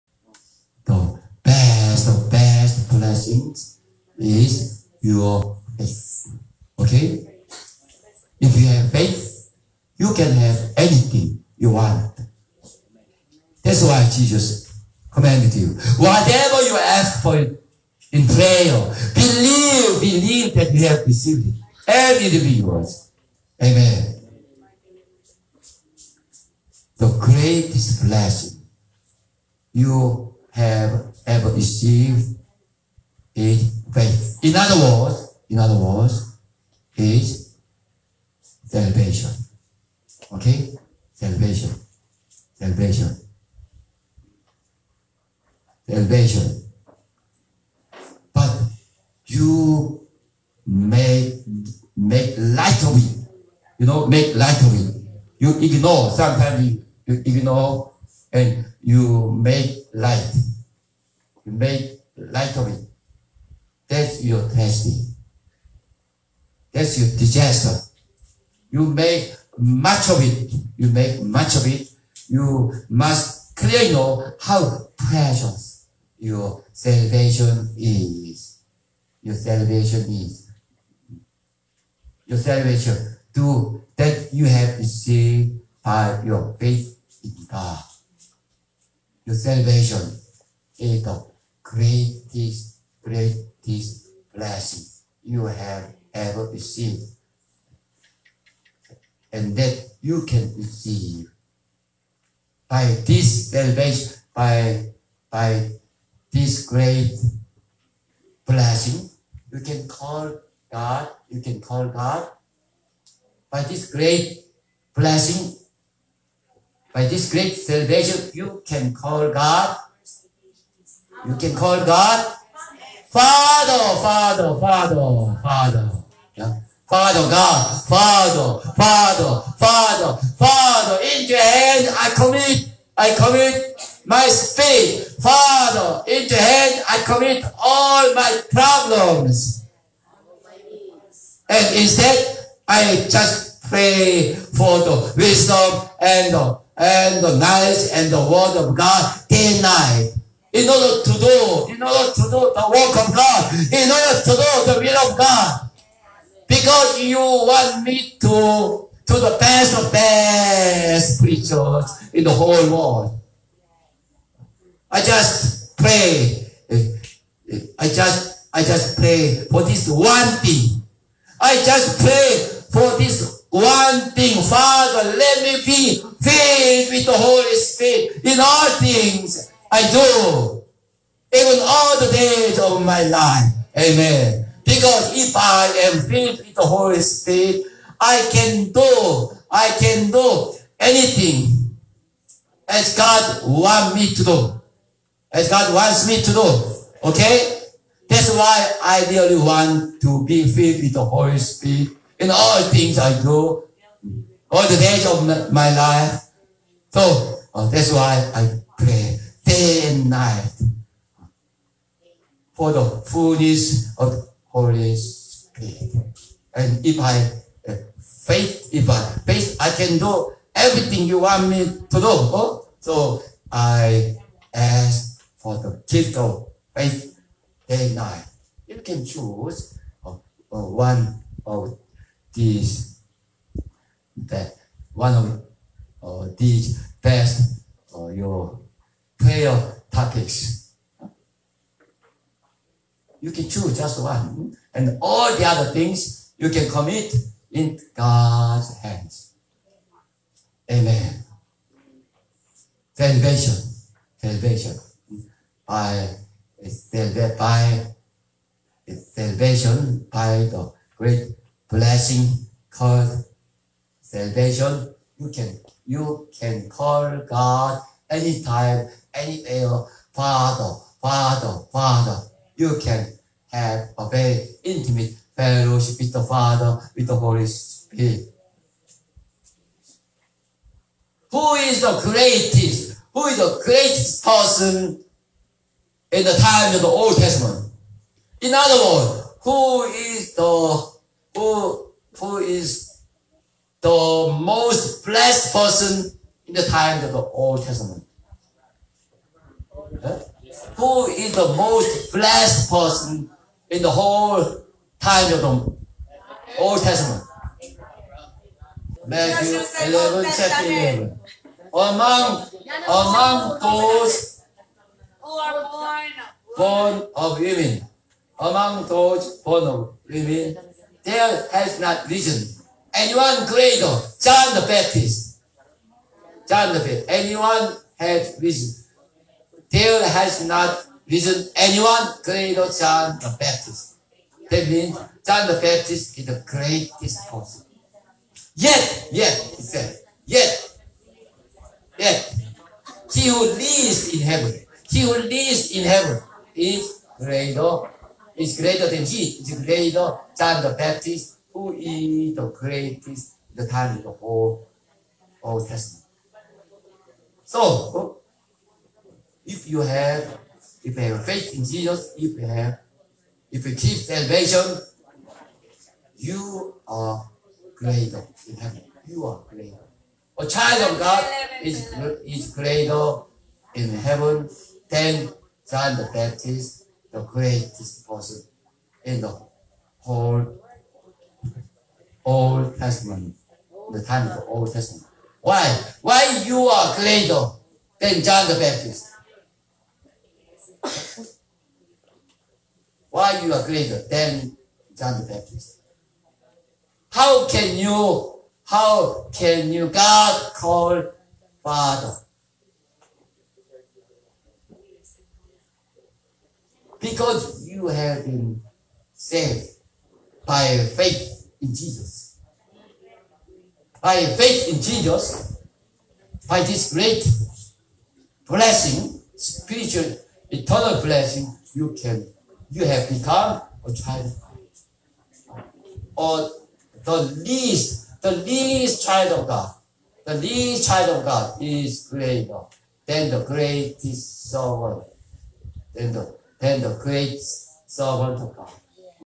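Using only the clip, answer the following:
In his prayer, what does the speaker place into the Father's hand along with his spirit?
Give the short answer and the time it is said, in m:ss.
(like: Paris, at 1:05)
all my problems, at 2:17.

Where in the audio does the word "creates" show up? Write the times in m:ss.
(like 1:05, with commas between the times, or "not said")
7:16.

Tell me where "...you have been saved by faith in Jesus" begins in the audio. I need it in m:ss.
6:47.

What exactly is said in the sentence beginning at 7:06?
Or the least, the least child of God, the least child of God is greater than the greatest sovereign.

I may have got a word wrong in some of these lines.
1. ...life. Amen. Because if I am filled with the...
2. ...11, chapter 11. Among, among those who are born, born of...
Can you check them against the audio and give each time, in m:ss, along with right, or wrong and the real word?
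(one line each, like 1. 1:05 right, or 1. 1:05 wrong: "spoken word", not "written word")
1. 3:03 right
2. 5:09 right.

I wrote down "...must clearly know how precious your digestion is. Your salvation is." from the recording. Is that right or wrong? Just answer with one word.
wrong.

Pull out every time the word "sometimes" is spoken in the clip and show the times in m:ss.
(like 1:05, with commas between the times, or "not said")
0:56.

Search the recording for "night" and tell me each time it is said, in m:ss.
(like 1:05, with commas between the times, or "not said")
2:29, 3:30, 3:47.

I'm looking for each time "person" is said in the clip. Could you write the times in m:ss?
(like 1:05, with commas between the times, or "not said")
4:44, 4:55, 5:02, 5:37, 6:18.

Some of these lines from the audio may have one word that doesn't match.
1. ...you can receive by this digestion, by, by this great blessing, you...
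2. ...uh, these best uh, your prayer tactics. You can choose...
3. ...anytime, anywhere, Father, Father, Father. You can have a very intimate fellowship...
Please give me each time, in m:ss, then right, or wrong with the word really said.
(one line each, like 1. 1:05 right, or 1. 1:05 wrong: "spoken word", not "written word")
1. 1:40 wrong: "salvation", not "digestion"
2. 3:56 right
3. 4:28 right.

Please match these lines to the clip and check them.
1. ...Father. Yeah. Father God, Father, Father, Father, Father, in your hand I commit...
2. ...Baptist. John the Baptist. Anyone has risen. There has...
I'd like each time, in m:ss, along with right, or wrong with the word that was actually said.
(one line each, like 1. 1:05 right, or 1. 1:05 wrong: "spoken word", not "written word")
1. 2:05 right
2. 5:24 right.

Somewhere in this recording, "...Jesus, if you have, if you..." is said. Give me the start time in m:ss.
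6:01.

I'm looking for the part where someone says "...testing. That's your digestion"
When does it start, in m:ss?
1:04.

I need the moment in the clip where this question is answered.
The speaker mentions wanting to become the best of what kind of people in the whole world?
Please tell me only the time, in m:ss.
2:41.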